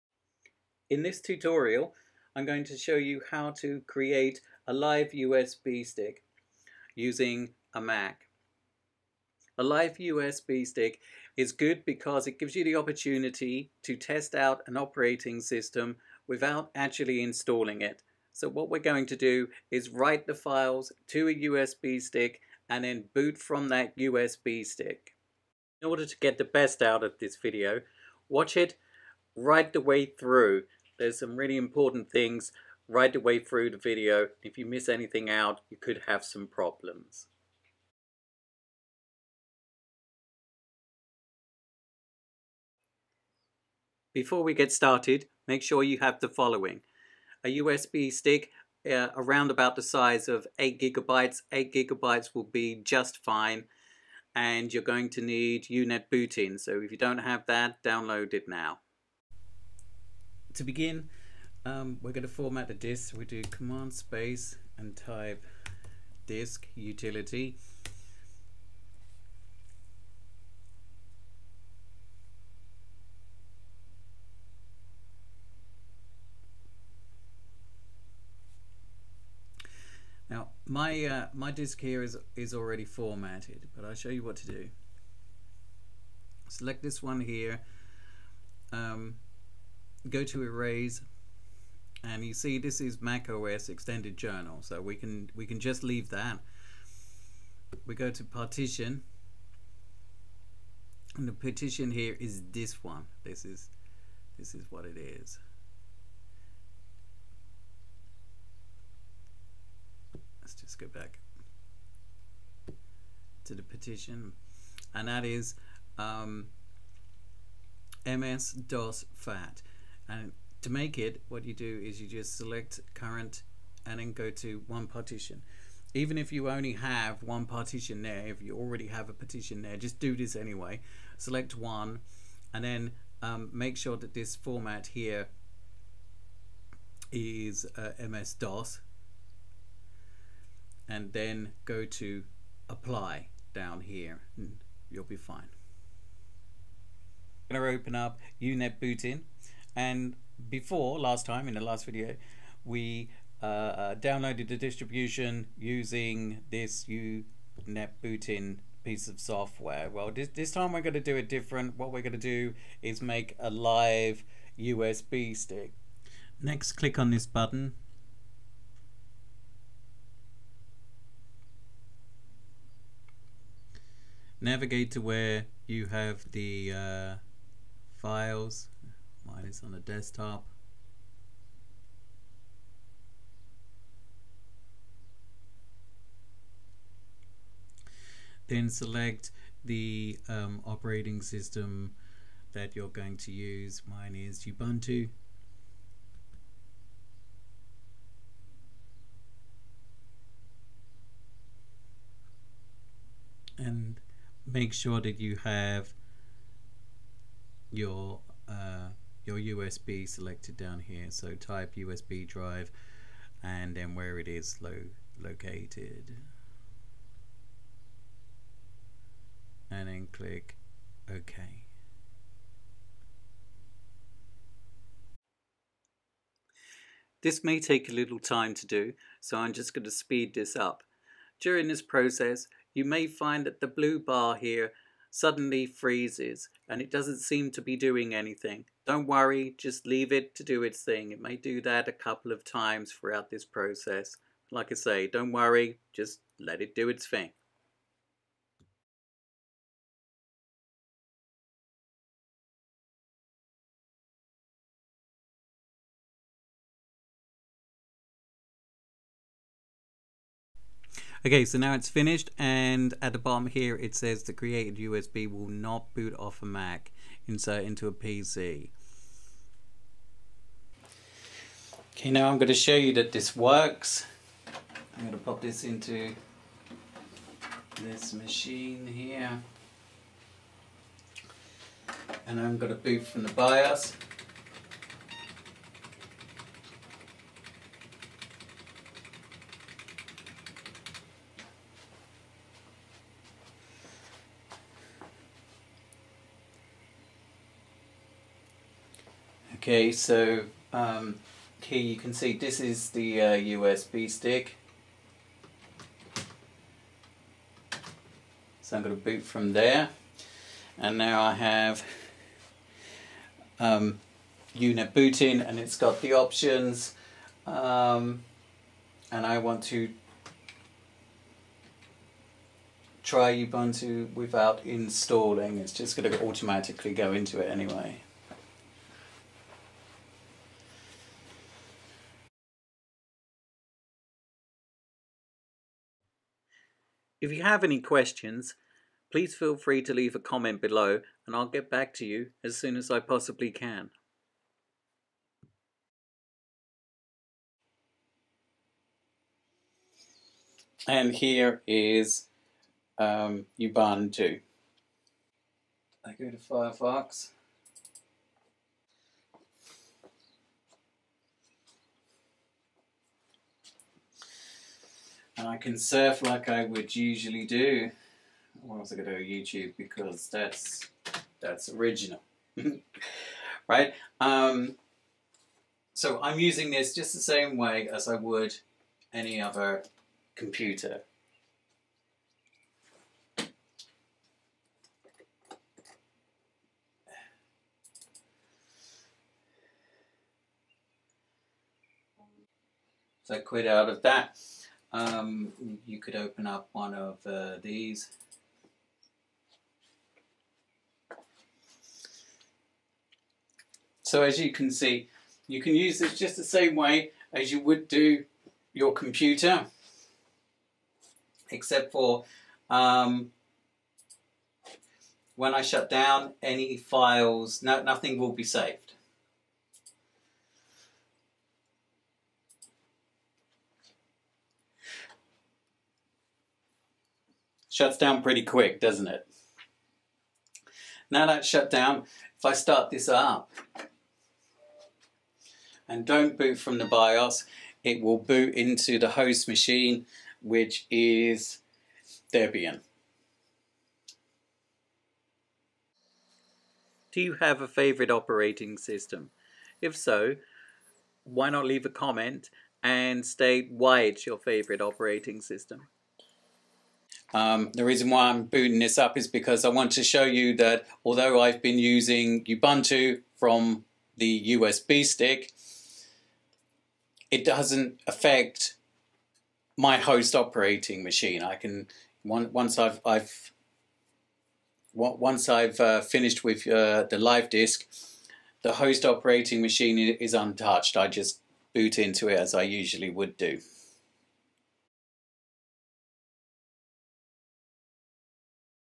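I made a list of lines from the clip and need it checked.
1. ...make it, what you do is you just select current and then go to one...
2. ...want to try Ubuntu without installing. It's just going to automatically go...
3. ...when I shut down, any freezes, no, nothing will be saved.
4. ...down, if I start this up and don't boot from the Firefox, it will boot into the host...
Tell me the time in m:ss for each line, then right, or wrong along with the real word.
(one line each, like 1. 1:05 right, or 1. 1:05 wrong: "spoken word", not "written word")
1. 2:00 right
2. 5:19 right
3. 6:55 wrong: "files", not "freezes"
4. 7:11 wrong: "BIOS", not "Firefox".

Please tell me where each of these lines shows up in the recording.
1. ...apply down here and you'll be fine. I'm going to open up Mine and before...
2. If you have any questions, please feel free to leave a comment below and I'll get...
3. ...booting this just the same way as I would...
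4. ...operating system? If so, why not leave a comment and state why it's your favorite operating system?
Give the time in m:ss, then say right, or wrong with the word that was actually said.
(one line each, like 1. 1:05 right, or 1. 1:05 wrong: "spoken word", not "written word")
1. 2:22 wrong: "UNet", not "Mine"
2. 5:37 right
3. 6:16 wrong: "using", not "booting"
4. 7:28 right.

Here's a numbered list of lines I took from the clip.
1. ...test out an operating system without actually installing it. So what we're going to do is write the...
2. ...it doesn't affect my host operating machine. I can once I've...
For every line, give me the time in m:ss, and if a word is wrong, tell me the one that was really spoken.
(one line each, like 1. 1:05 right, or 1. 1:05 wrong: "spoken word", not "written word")
1. 0:13 right
2. 7:47 right.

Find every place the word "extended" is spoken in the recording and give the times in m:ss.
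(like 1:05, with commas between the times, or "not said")
1:33.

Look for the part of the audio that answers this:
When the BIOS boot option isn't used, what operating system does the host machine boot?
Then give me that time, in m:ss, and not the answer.
7:22.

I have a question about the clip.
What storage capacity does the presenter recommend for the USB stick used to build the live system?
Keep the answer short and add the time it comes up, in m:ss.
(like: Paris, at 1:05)
8 gigabytes, at 0:49.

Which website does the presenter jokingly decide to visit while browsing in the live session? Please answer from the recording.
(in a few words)
YouTube.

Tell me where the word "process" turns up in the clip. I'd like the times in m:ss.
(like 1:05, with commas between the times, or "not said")
3:51, 4:03.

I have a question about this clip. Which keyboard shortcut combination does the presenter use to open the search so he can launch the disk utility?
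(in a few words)
command space.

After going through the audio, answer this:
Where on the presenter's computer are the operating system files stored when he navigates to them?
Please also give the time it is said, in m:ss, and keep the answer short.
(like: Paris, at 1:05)
the desktop, at 2:59.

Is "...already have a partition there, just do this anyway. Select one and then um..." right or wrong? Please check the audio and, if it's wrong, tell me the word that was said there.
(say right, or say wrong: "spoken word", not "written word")
right.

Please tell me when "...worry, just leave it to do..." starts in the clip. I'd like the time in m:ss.
3:59.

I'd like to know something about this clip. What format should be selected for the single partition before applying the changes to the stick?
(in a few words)
MS-DOS.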